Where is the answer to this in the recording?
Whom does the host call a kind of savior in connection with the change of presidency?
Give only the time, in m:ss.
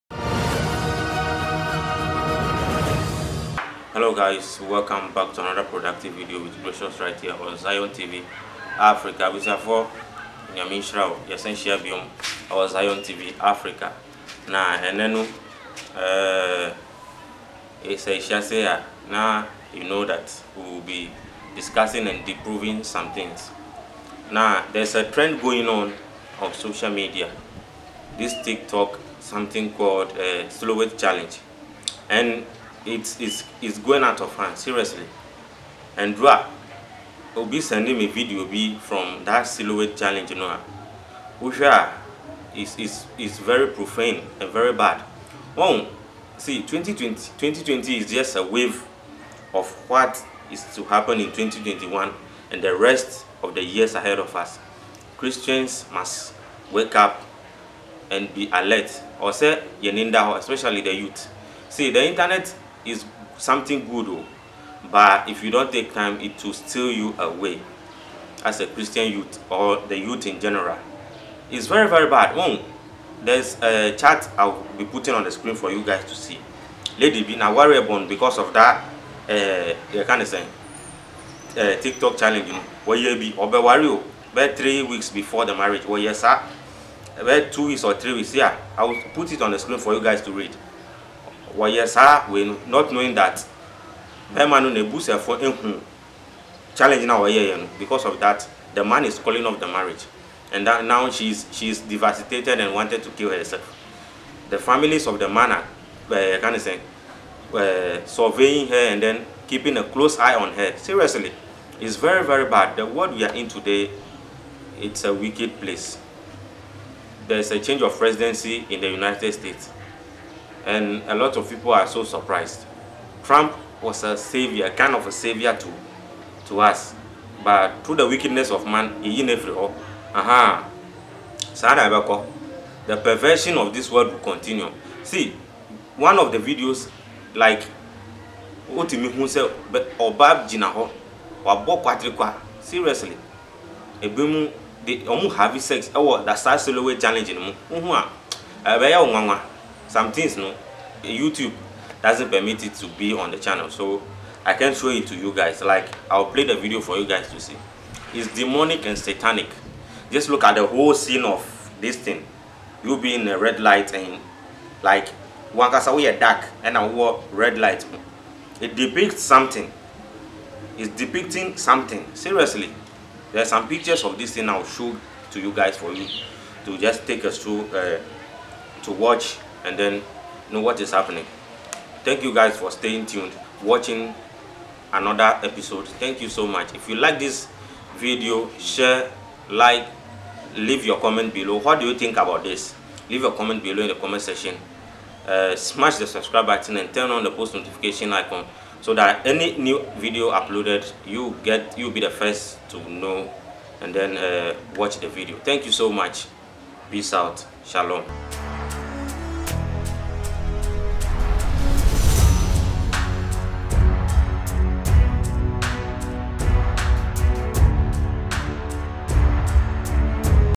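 2:03.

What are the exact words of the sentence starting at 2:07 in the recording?
But through the wickedness of man, he in every aha, Sadabako, the perversion of this world will continue.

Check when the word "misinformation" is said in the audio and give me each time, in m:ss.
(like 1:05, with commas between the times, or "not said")
not said.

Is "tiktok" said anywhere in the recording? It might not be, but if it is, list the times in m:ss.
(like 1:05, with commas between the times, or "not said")
0:28, 1:21.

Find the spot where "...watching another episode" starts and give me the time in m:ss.
3:03.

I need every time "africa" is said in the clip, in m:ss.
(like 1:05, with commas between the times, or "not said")
0:08, 0:13.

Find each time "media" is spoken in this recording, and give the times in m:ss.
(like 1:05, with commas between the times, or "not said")
0:26.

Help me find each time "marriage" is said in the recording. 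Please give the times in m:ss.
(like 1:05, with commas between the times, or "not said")
1:25, 1:39.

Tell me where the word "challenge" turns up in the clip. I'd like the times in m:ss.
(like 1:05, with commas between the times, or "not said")
0:30, 0:39, 1:22, 1:36, 2:26.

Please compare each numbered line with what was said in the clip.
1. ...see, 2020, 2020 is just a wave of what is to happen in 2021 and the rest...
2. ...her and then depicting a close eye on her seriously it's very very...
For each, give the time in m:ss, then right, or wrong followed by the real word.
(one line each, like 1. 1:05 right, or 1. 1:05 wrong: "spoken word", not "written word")
1. 0:46 right
2. 1:48 wrong: "keeping", not "depicting".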